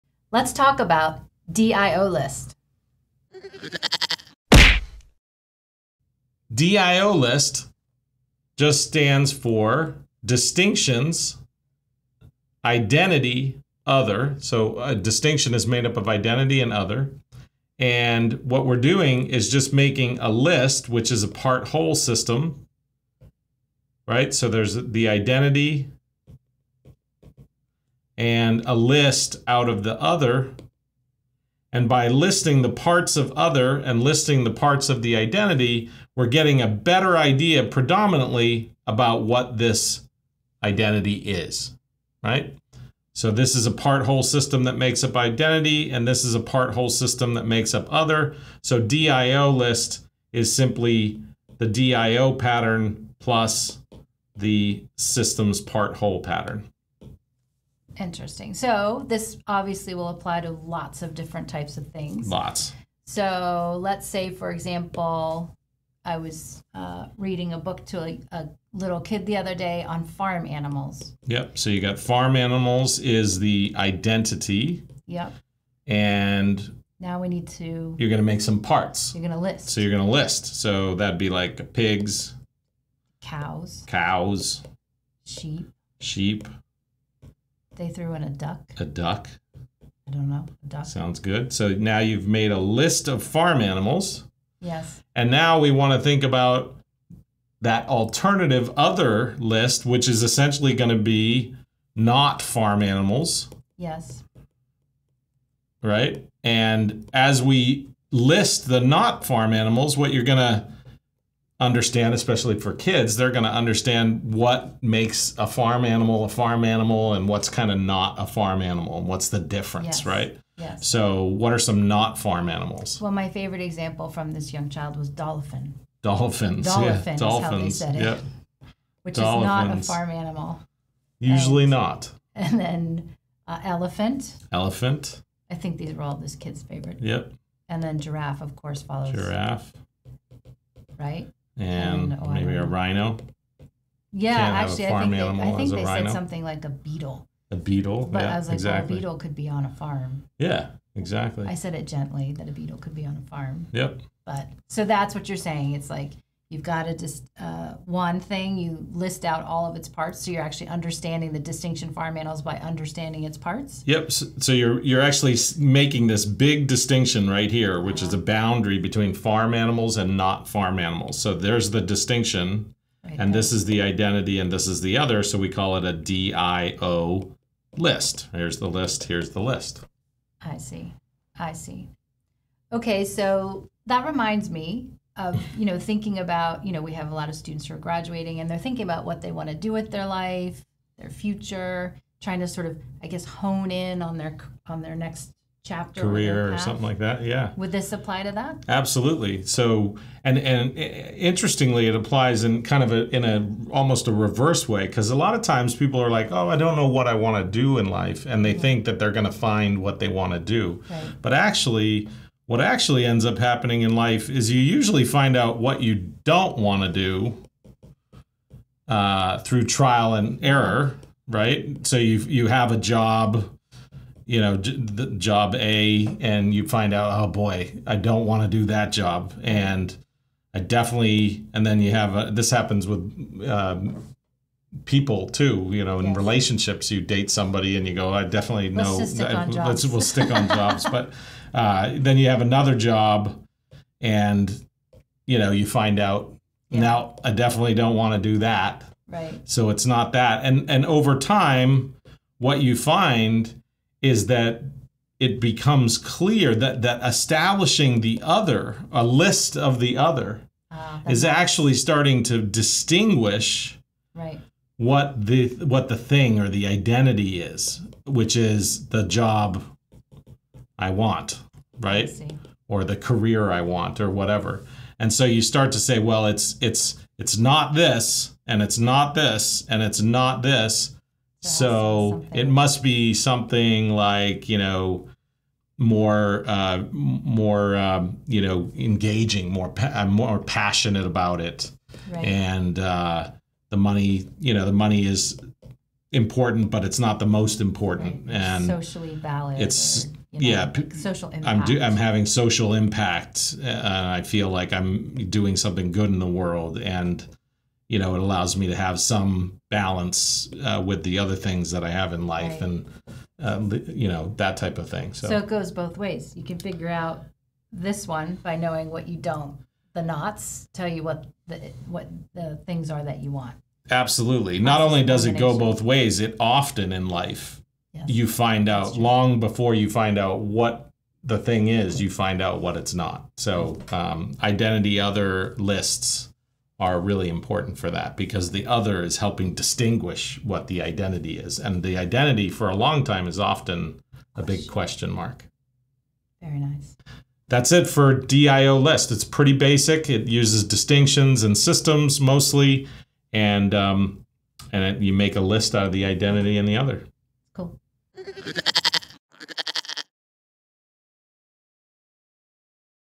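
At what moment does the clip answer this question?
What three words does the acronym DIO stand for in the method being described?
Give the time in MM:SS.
00:10.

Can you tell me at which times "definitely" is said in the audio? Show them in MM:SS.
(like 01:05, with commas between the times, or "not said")
03:50, 03:58, 04:07.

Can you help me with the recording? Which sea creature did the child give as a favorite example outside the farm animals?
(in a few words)
Dolphin.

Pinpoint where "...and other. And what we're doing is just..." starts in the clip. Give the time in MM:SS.
00:16.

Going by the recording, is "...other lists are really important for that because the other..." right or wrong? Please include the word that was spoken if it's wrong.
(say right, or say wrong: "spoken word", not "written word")
right.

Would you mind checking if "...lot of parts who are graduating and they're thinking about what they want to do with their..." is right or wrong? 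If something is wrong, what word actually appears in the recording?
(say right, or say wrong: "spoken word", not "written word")
wrong: "students", not "parts".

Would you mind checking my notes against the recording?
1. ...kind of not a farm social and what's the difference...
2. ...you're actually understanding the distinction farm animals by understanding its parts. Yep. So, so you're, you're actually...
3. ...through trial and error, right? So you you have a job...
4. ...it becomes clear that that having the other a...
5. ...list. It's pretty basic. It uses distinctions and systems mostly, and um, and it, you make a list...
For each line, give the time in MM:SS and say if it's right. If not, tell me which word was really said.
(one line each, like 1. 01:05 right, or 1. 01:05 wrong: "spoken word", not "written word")
1. 01:57 wrong: "animal", not "social"
2. 02:40 right
3. 03:39 right
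4. 04:15 wrong: "establishing", not "having"
5. 05:48 right.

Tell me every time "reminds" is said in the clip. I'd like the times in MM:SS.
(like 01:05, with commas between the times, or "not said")
03:04.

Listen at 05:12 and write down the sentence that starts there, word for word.
and uh, you know, that type of thing.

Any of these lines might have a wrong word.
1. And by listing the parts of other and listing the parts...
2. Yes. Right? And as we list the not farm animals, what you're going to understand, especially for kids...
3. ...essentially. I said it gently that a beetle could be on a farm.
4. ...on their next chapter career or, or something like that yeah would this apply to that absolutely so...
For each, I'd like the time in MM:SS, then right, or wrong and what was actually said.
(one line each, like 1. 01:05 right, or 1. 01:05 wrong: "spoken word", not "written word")
1. 00:31 right
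2. 01:43 right
3. 02:30 wrong: "exactly", not "essentially"
4. 03:14 right.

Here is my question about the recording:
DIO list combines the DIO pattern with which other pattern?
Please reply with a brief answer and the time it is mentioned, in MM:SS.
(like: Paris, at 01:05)
Systems part whole pattern, at 00:54.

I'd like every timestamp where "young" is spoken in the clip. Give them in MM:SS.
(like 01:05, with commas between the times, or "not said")
02:04.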